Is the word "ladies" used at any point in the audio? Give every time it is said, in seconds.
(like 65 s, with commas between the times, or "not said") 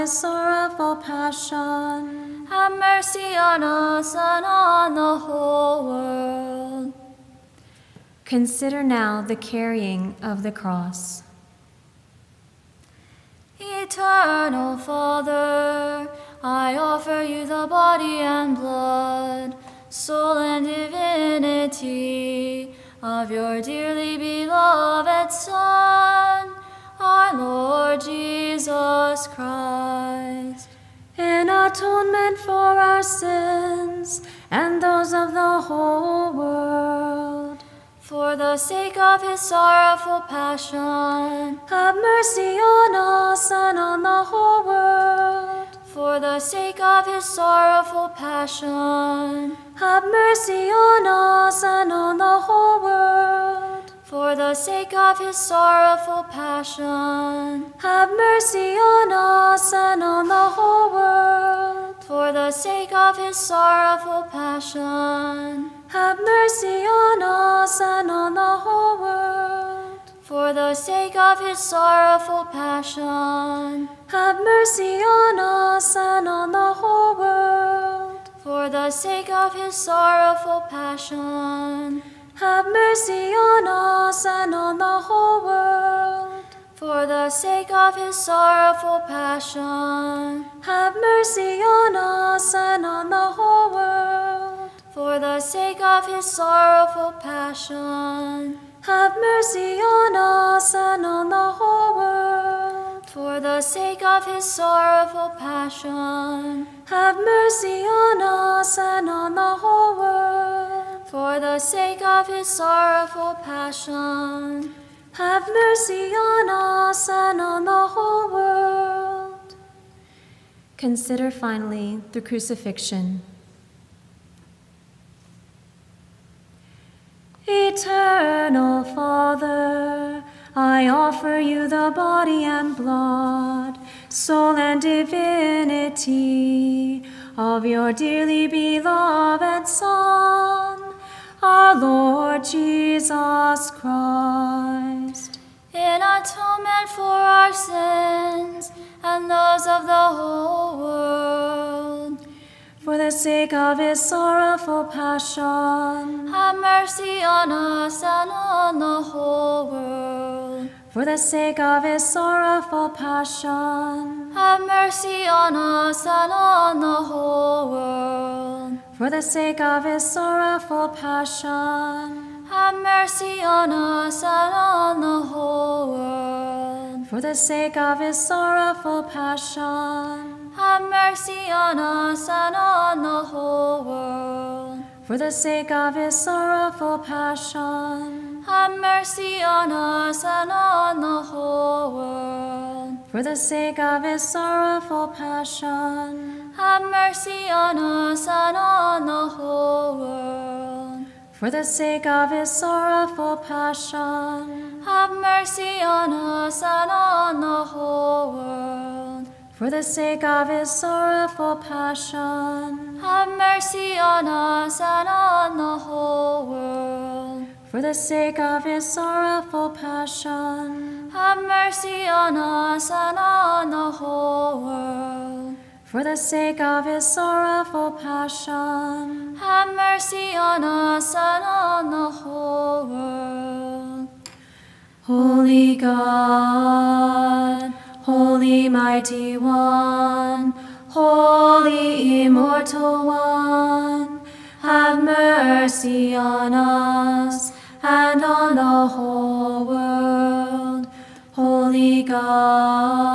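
not said.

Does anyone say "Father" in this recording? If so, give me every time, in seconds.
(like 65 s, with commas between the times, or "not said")
14 s, 128 s.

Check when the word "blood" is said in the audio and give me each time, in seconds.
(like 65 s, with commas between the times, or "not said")
18 s, 132 s.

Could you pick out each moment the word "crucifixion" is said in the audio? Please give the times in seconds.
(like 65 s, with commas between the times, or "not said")
122 s.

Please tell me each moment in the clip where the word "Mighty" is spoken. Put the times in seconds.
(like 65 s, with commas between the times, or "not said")
238 s.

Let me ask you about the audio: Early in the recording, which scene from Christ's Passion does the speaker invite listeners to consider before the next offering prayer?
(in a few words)
The carrying of the cross.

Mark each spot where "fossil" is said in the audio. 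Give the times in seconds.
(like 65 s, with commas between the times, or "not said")
not said.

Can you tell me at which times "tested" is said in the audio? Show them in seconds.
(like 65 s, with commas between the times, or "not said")
not said.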